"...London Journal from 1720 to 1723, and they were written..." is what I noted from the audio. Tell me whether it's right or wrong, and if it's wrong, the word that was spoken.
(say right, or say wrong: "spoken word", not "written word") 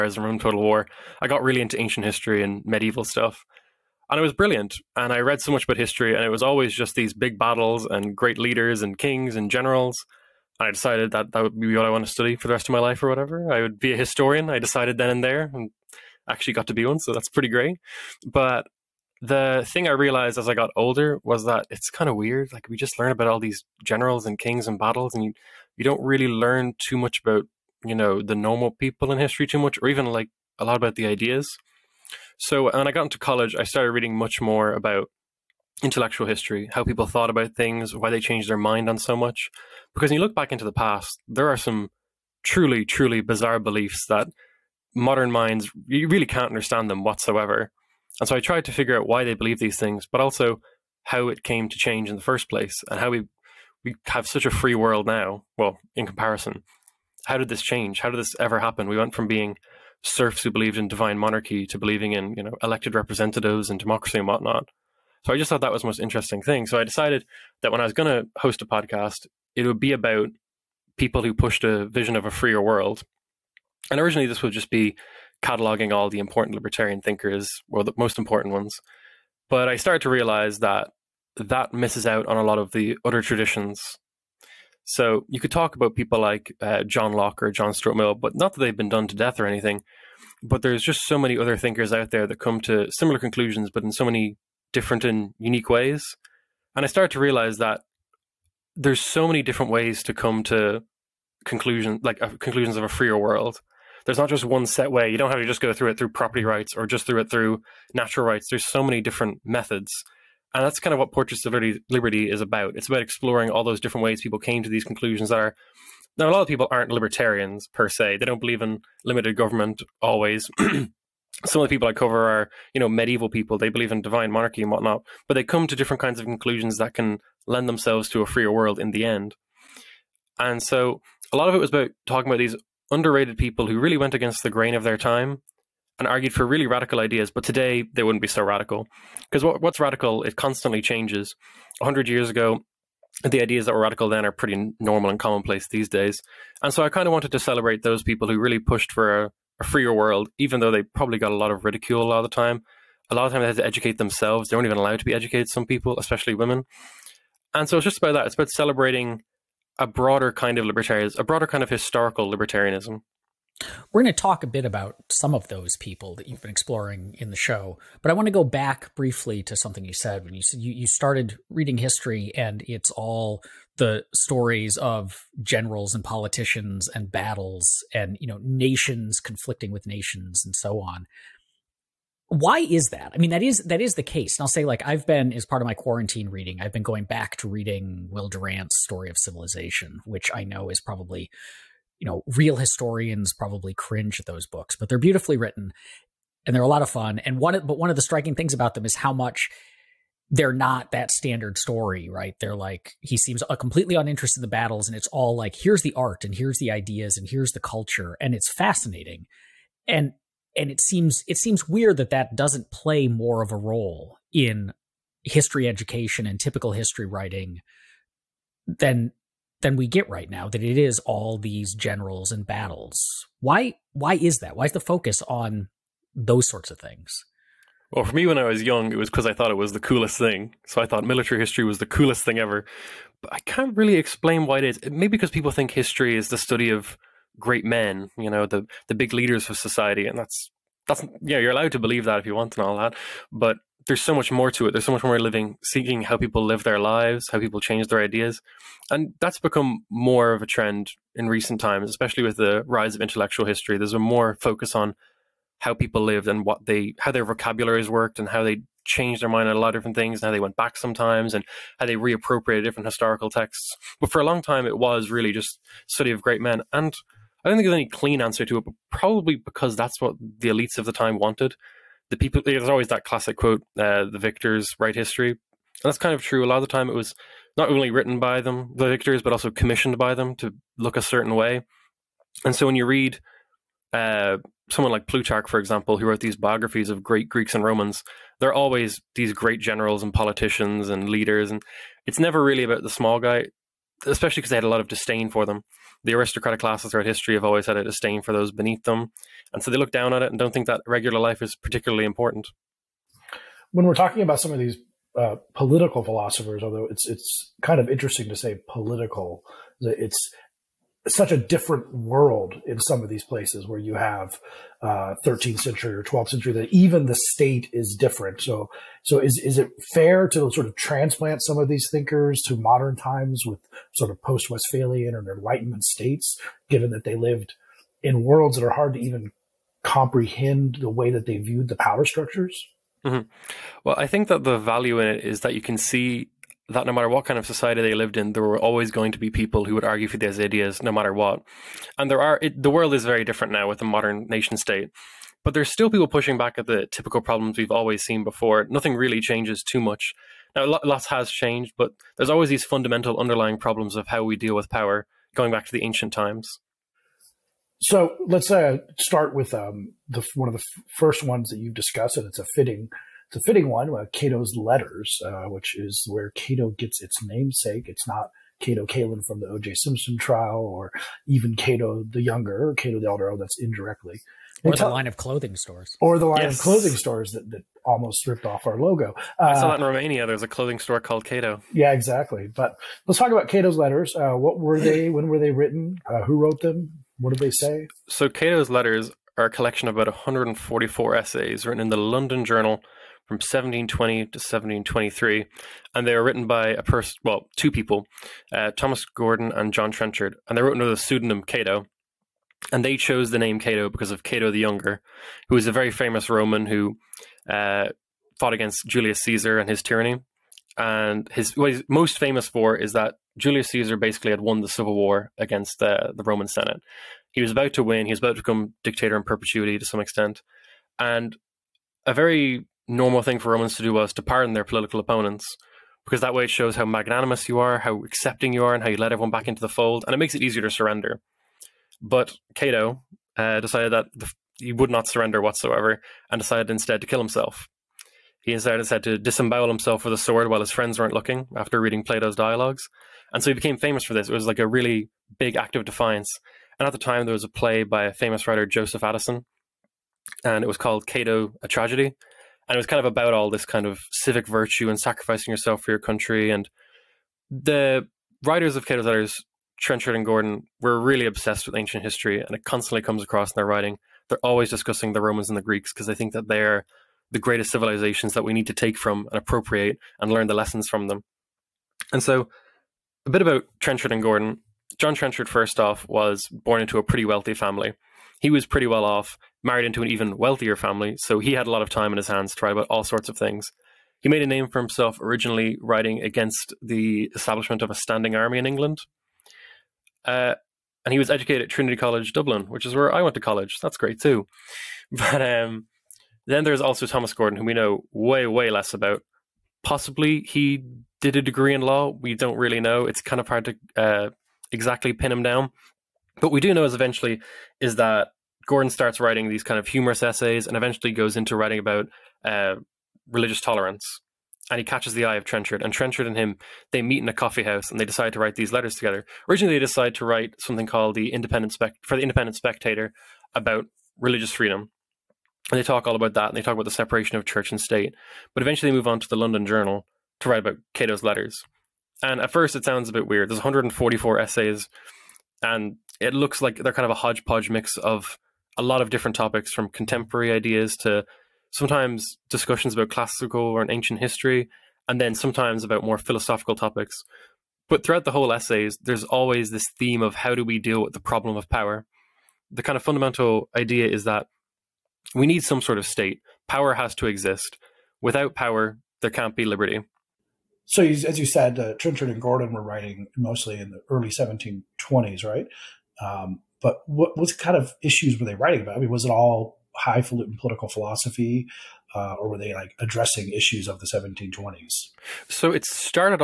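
right.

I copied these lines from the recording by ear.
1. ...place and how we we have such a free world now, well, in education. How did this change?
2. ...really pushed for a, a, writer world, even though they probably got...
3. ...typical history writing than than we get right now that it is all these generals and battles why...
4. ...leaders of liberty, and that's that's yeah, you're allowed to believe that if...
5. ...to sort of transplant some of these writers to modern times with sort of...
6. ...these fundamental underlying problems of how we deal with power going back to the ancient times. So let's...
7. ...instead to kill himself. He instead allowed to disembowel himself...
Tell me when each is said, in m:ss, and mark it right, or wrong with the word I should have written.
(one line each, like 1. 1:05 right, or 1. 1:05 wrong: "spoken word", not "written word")
1. 0:52 wrong: "comparison", not "education"
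2. 2:28 wrong: "freer", not "writer"
3. 3:36 right
4. 3:59 wrong: "society", not "liberty"
5. 5:20 wrong: "thinkers", not "writers"
6. 5:52 right
7. 7:16 wrong: "decided", not "allowed".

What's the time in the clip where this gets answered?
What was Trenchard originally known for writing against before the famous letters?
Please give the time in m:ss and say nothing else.
8:07.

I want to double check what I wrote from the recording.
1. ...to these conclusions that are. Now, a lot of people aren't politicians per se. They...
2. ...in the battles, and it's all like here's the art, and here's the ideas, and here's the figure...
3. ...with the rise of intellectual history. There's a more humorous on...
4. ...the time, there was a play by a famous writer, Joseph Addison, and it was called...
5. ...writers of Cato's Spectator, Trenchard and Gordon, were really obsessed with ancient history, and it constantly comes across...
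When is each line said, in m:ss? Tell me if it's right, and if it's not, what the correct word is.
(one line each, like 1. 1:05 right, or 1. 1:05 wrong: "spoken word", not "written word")
1. 1:54 wrong: "libertarians", not "politicians"
2. 3:24 wrong: "culture", not "figure"
3. 4:12 wrong: "focus", not "humorous"
4. 7:26 right
5. 7:38 wrong: "Letters", not "Spectator".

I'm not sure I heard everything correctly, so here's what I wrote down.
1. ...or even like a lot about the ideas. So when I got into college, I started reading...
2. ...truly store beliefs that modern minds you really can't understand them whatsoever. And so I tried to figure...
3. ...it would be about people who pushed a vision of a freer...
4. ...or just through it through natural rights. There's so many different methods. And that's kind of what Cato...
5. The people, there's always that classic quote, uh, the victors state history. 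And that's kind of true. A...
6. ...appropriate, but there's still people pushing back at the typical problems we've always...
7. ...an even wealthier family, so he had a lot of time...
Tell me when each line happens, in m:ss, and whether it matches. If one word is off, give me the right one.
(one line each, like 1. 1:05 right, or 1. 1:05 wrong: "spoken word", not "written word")
1. 0:29 right
2. 0:42 wrong: "bizarre", not "store"
3. 1:09 right
4. 1:46 wrong: "Portraits", not "Cato"
5. 4:32 wrong: "write", not "state"
6. 5:44 wrong: "state", not "appropriate"
7. 8:00 right.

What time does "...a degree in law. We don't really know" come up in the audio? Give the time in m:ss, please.
8:21.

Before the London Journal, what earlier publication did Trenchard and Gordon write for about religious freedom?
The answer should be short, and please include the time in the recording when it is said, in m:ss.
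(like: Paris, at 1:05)
Independent Spectator, at 8:42.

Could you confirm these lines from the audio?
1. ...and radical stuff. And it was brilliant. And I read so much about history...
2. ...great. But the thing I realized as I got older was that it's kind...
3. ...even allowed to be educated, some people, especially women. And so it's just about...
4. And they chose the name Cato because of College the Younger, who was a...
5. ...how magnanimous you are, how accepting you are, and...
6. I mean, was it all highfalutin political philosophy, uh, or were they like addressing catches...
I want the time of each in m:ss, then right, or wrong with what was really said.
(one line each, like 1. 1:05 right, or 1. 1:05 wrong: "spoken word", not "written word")
1. 0:02 wrong: "medieval", not "radical"
2. 0:17 right
3. 2:34 right
4. 6:42 wrong: "Cato", not "College"
5. 7:06 right
6. 9:28 wrong: "issues", not "catches".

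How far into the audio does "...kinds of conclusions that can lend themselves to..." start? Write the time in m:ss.
2:05.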